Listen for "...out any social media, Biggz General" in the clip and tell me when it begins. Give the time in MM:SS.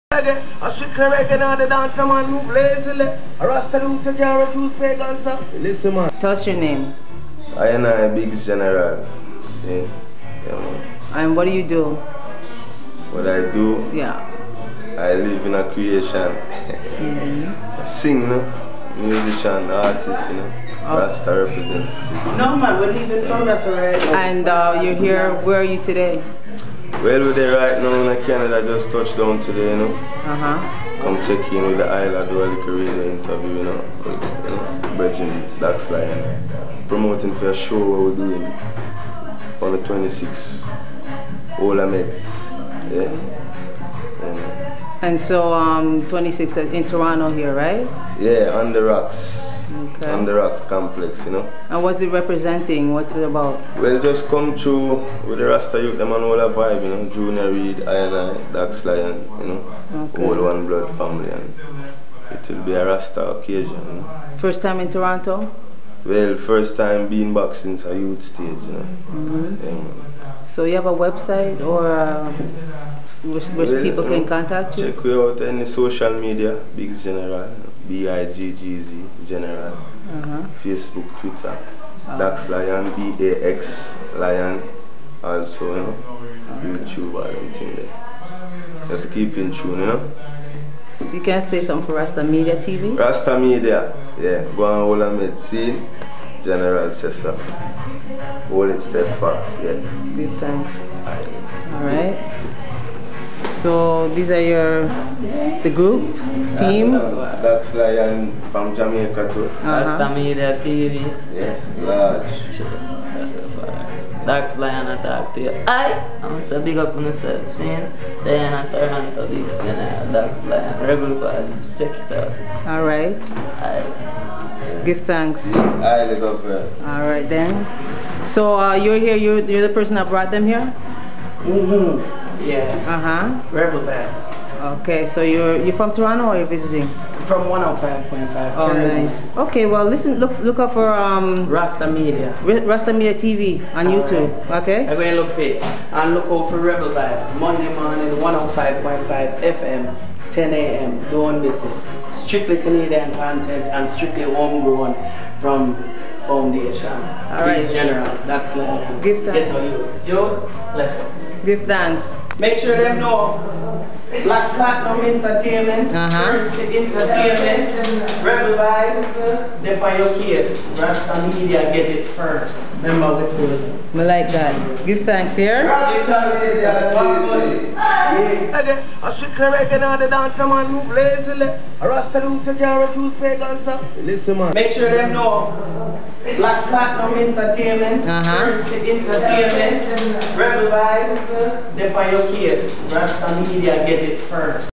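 01:15.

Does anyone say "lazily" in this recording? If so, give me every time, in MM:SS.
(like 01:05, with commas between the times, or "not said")
00:02.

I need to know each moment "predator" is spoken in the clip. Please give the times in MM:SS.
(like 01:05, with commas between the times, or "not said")
not said.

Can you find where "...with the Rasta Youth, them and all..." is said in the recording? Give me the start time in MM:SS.
00:55.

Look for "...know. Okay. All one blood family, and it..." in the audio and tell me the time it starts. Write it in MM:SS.
00:59.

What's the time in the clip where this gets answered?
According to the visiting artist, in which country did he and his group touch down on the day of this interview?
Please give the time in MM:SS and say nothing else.
00:28.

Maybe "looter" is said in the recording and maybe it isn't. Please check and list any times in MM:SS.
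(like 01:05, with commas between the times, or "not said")
00:03.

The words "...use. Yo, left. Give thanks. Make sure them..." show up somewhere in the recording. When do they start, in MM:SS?
02:39.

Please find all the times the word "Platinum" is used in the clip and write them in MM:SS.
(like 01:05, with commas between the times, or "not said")
02:44, 03:06.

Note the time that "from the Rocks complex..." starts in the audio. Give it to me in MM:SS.
00:50.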